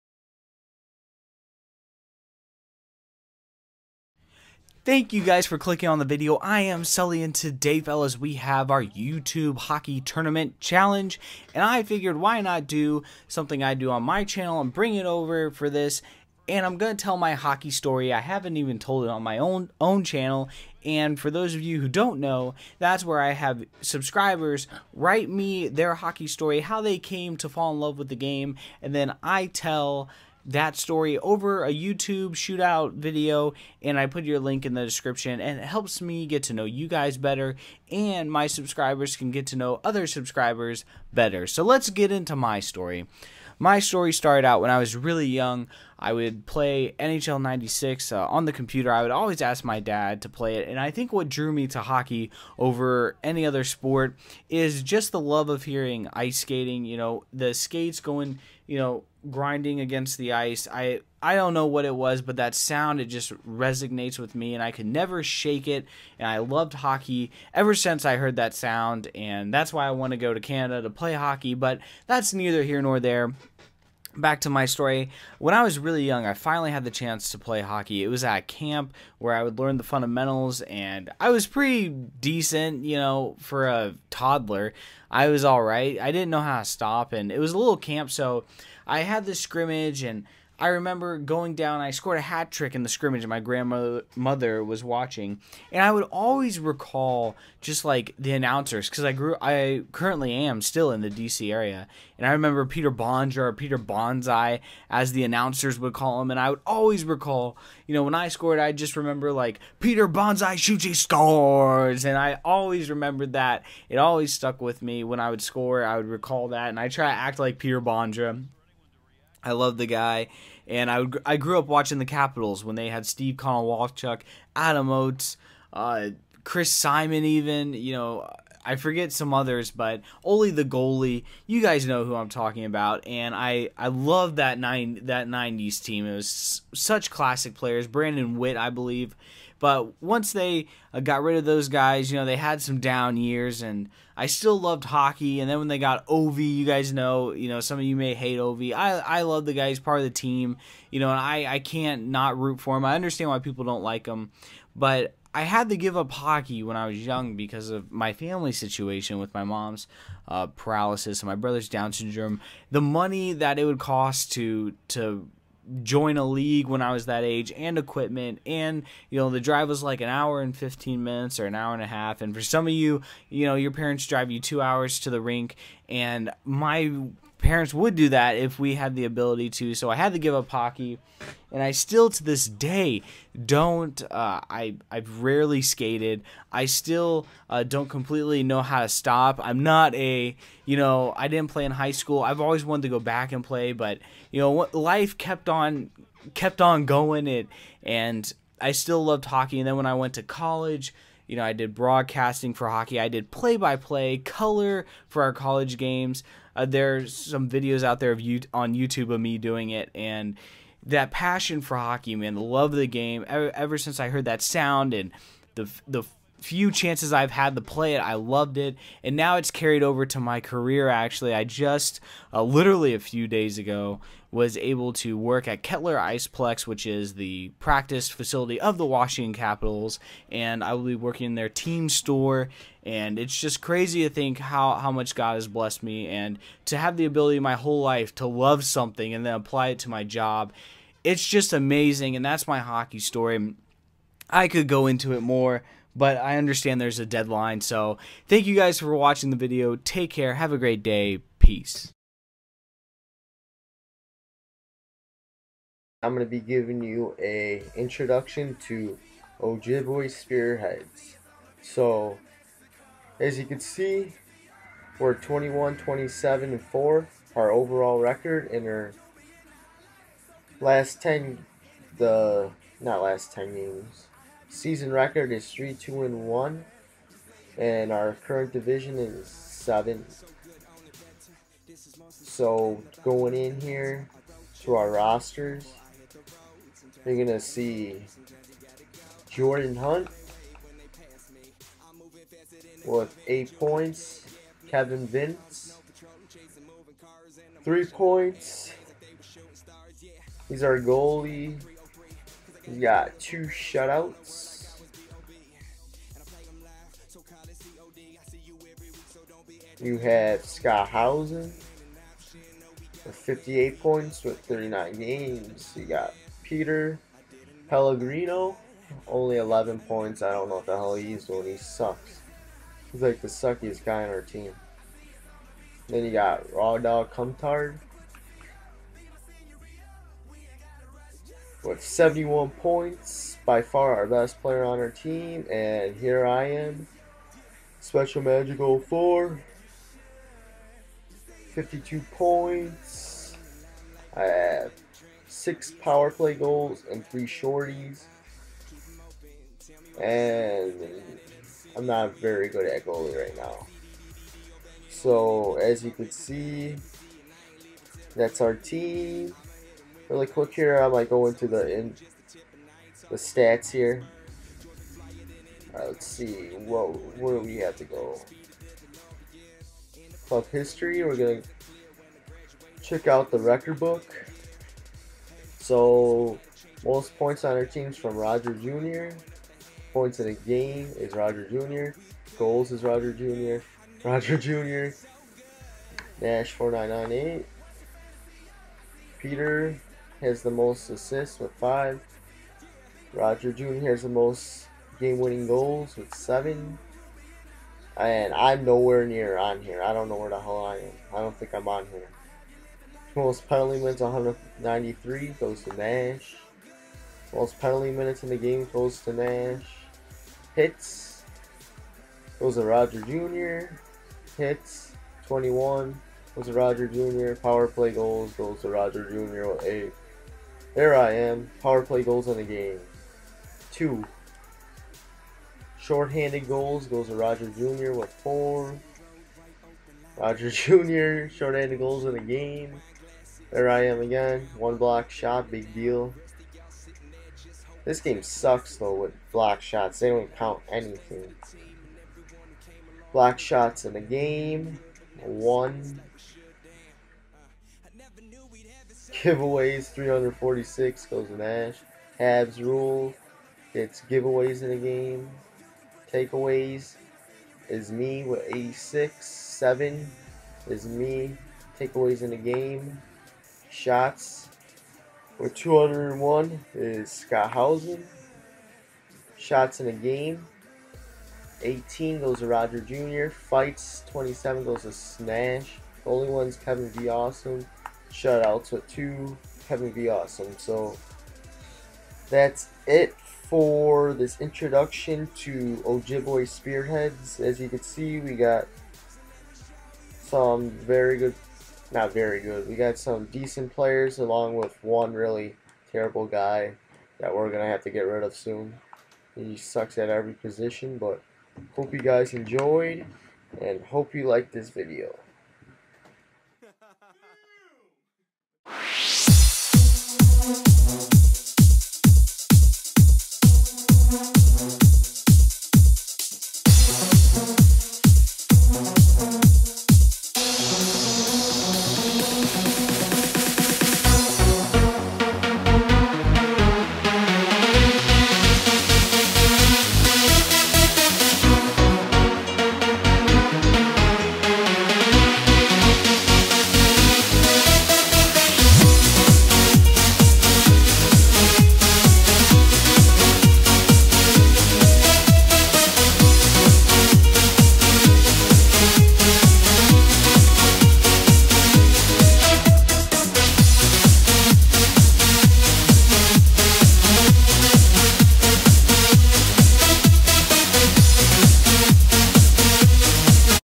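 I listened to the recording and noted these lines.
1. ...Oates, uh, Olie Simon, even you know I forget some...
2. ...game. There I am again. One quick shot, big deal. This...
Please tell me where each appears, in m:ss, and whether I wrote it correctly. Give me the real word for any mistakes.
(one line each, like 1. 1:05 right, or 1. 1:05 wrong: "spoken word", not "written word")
1. 2:04 wrong: "Chris", not "Olie"
2. 7:12 wrong: "block", not "quick".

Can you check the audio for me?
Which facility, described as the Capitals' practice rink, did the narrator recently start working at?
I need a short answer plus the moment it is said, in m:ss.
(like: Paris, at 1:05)
Kettler Iceplex, at 3:45.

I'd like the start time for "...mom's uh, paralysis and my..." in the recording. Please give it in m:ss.
2:39.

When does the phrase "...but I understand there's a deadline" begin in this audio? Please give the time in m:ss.
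4:05.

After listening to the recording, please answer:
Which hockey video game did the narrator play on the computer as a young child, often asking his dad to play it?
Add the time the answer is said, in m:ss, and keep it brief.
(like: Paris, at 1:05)
NHL 96, at 0:46.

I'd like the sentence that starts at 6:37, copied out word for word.
And I'm nowhere near on here.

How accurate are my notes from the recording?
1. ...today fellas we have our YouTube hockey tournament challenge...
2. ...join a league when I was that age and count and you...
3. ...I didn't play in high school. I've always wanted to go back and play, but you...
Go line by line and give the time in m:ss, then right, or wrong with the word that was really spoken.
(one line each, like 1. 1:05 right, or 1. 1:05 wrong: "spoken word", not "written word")
1. 0:07 right
2. 2:45 wrong: "equipment", not "count"
3. 3:11 right.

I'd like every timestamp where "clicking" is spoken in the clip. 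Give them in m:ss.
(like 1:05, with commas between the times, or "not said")
0:05.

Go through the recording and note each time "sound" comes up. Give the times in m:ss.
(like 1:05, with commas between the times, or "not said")
1:02, 1:08, 3:34.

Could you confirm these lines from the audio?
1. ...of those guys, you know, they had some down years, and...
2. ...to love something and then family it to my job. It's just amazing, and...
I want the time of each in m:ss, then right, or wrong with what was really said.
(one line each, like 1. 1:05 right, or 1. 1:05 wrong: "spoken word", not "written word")
1. 2:21 right
2. 3:58 wrong: "apply", not "family".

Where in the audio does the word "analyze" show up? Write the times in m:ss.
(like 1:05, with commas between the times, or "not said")
not said.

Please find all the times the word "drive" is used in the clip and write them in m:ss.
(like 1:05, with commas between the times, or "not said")
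2:49, 2:54.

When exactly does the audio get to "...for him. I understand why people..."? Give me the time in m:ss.
2:32.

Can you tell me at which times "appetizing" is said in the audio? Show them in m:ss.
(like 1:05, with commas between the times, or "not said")
not said.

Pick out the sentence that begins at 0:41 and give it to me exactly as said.
So let's get into my story.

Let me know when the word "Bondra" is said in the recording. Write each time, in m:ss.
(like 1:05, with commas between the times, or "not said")
1:42, 1:57.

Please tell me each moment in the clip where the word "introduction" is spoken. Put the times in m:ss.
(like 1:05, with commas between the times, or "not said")
4:17, 8:04.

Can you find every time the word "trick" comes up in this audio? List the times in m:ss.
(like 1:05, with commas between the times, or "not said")
1:32.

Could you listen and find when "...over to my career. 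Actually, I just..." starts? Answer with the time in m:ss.
3:39.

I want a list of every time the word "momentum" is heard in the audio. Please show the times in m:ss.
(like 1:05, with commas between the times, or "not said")
not said.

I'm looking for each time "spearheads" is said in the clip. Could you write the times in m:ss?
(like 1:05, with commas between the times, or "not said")
4:20, 8:06.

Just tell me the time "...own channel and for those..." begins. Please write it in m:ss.
0:19.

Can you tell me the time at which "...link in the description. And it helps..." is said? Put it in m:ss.
0:34.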